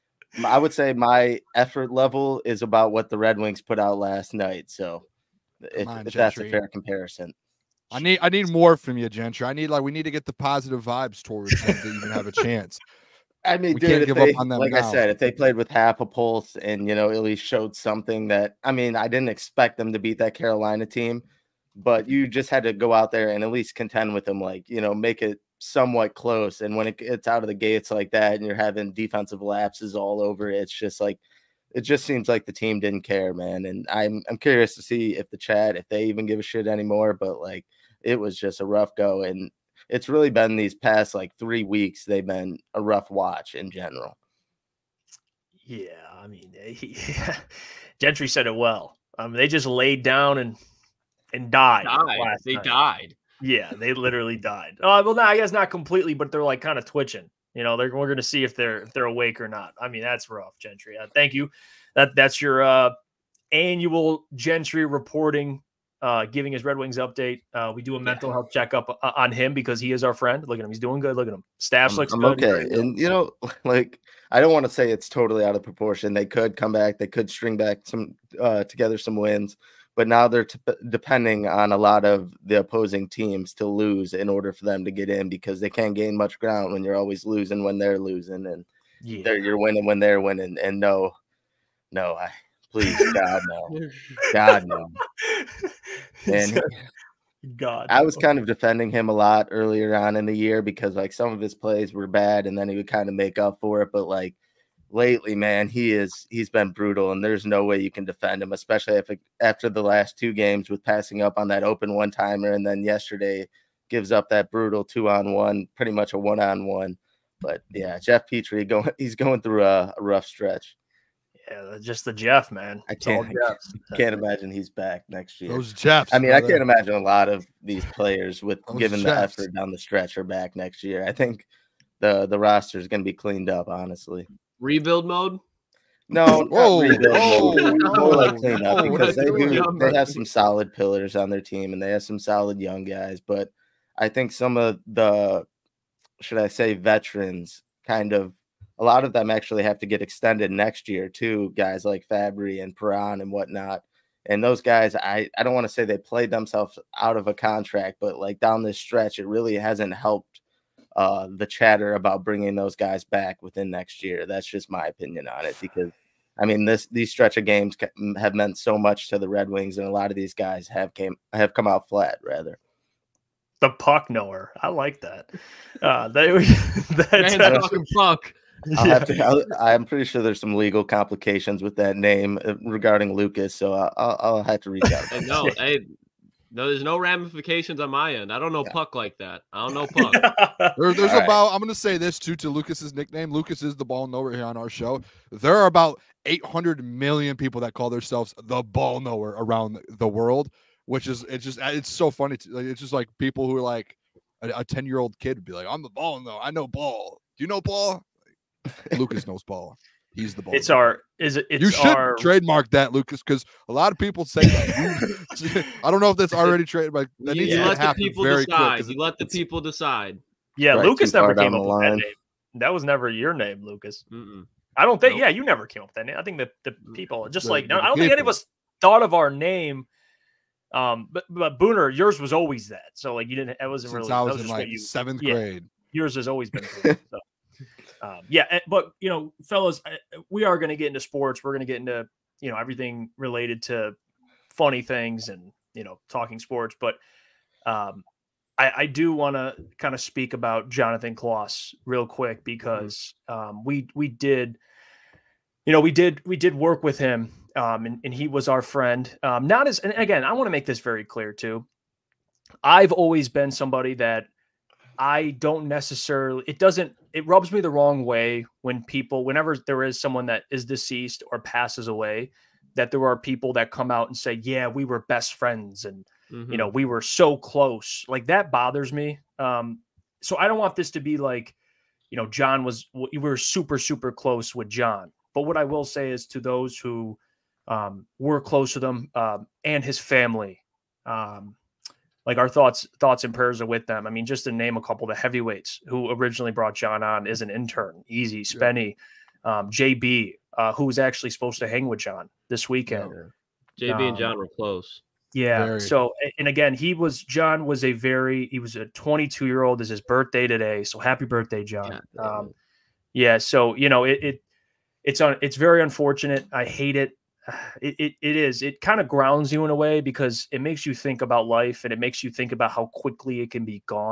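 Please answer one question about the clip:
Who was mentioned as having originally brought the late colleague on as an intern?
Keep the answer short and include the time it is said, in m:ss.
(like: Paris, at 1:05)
Easy Spenny, at 4:58.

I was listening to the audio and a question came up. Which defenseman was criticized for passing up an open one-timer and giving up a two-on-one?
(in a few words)
Jeff Petry.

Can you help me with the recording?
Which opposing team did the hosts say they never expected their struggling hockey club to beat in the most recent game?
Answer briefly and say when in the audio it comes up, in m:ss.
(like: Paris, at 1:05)
Carolina, at 0:20.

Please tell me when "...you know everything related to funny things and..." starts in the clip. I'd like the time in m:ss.
4:02.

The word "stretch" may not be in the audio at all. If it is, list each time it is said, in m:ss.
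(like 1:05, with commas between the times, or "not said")
2:00, 2:09, 2:38, 2:47.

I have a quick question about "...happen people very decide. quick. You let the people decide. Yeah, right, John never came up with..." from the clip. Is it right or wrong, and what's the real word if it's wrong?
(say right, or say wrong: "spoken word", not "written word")
wrong: "Lukas", not "John".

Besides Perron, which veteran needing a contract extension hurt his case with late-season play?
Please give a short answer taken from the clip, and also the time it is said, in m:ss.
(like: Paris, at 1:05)
Fabbri, at 2:32.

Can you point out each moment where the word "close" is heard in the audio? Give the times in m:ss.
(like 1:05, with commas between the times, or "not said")
0:26, 4:37, 4:44, 4:48, 5:04.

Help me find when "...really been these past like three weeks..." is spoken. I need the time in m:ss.
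0:40.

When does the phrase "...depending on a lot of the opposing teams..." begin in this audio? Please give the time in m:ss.
1:20.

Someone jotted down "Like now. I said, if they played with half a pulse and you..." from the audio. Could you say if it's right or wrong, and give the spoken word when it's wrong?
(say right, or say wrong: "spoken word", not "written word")
right.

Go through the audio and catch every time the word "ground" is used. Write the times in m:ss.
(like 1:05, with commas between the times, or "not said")
1:26, 5:19.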